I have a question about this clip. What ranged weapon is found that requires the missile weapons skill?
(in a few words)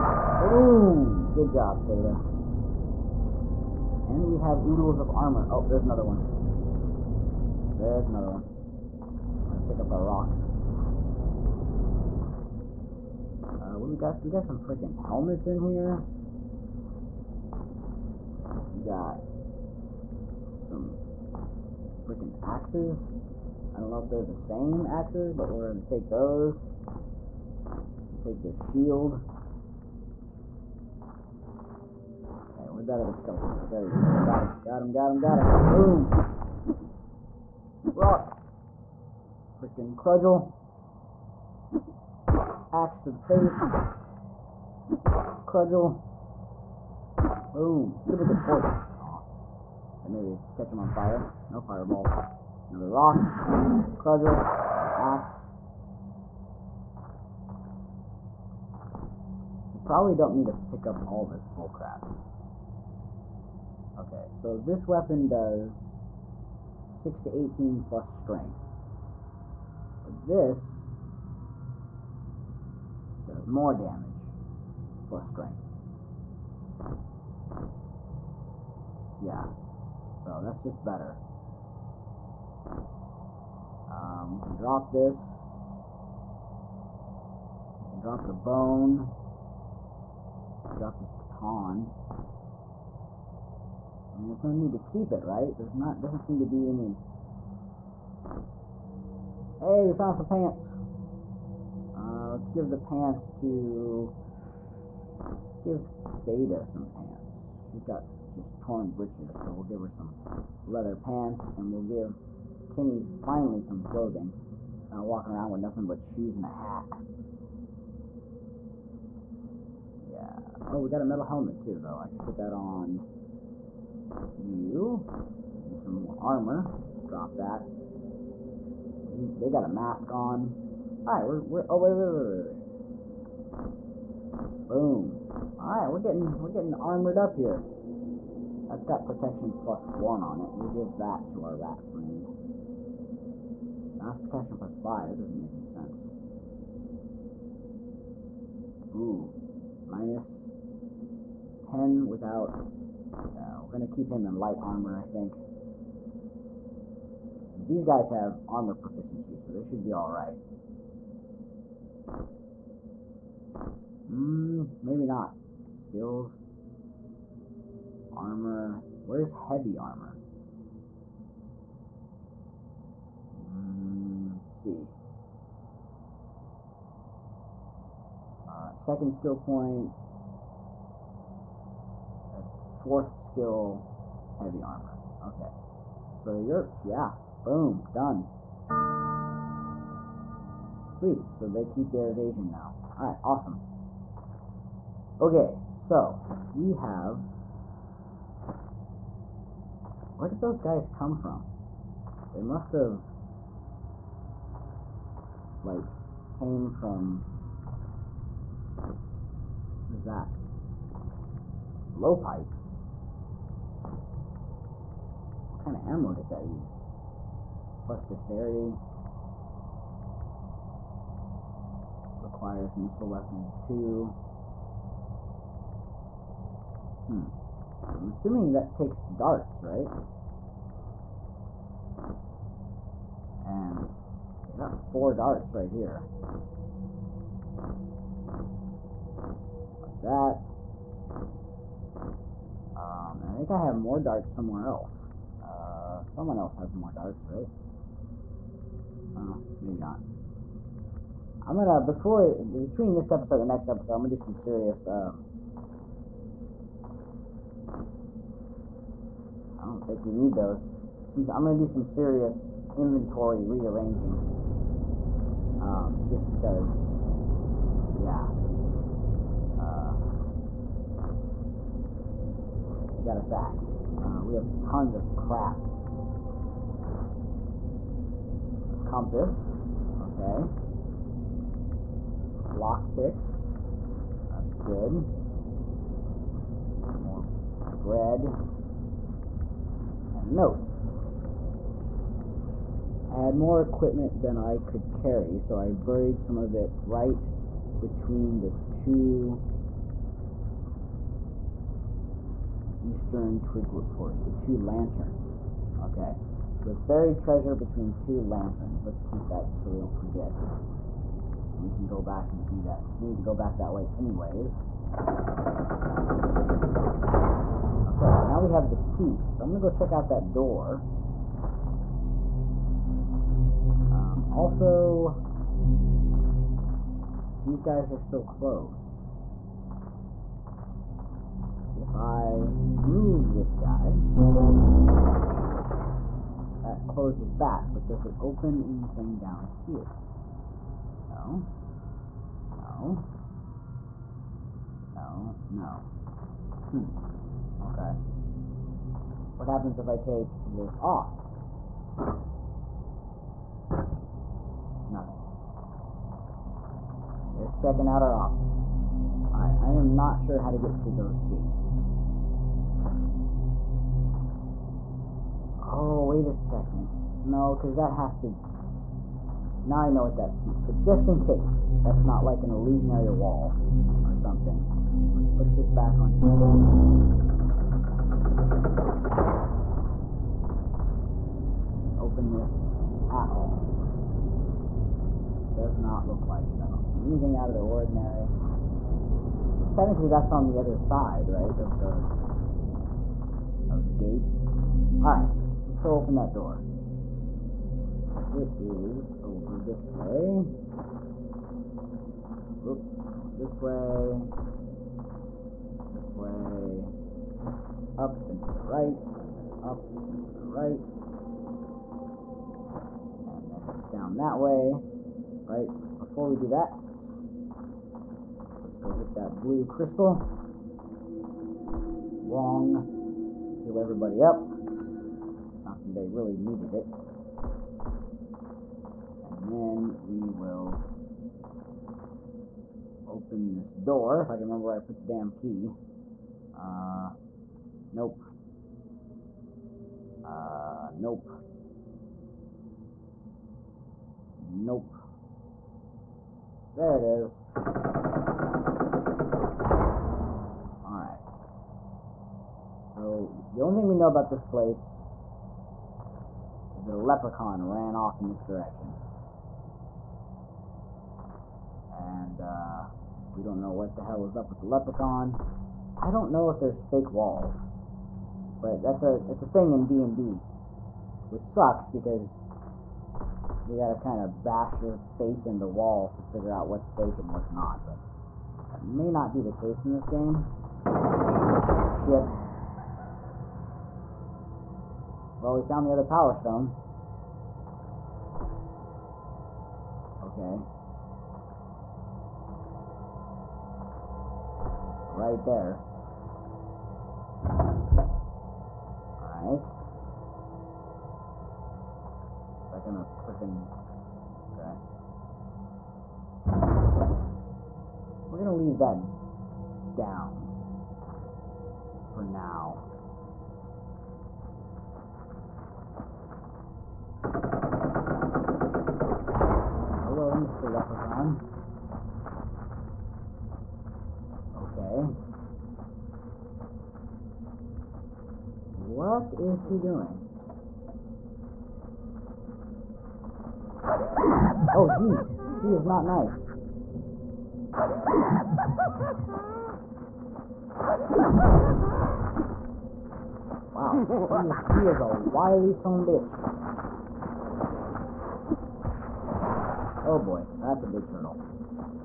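Blowpipe.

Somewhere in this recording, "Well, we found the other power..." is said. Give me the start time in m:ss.
8:05.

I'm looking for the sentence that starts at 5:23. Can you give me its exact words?
Um, also, these guys are still closed.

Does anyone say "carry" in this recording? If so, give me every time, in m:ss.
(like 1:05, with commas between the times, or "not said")
4:54.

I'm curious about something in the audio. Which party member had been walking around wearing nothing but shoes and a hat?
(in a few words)
Kenny.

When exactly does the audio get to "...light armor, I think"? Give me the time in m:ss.
2:34.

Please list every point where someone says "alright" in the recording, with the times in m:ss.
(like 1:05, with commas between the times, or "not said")
2:11, 2:15, 2:39, 3:12, 6:35, 7:30, 8:19.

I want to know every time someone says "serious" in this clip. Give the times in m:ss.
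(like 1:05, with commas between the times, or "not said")
4:14, 4:21.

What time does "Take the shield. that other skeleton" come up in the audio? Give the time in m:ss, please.
0:28.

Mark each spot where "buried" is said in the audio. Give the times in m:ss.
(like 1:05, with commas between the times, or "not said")
4:55, 5:06.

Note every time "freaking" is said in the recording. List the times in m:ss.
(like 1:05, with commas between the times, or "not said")
0:14, 0:22, 0:39, 8:23.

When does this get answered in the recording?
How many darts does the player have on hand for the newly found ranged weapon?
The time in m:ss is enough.
3:54.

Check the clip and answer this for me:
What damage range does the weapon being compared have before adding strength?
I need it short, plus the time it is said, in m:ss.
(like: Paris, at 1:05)
6 to 18, at 1:06.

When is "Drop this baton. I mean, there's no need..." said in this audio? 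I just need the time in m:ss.
1:30.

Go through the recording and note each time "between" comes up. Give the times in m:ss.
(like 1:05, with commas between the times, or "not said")
4:12, 4:57, 5:07.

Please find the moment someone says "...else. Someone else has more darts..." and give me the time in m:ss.
4:04.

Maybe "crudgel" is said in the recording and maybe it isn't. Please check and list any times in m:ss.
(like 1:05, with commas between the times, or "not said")
0:39, 0:45, 0:53.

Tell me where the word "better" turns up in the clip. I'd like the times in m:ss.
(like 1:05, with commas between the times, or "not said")
1:20.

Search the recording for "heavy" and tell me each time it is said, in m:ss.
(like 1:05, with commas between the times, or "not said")
2:49, 3:04.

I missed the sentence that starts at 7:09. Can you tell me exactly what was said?
And then we will open this door, if I can remember where I put the damn key.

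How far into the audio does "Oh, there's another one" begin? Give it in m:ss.
0:05.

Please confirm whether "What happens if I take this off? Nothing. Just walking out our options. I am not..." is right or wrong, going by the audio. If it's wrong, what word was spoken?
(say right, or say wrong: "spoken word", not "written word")
wrong: "checking", not "walking".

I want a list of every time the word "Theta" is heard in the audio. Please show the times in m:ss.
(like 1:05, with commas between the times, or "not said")
0:01, 1:46.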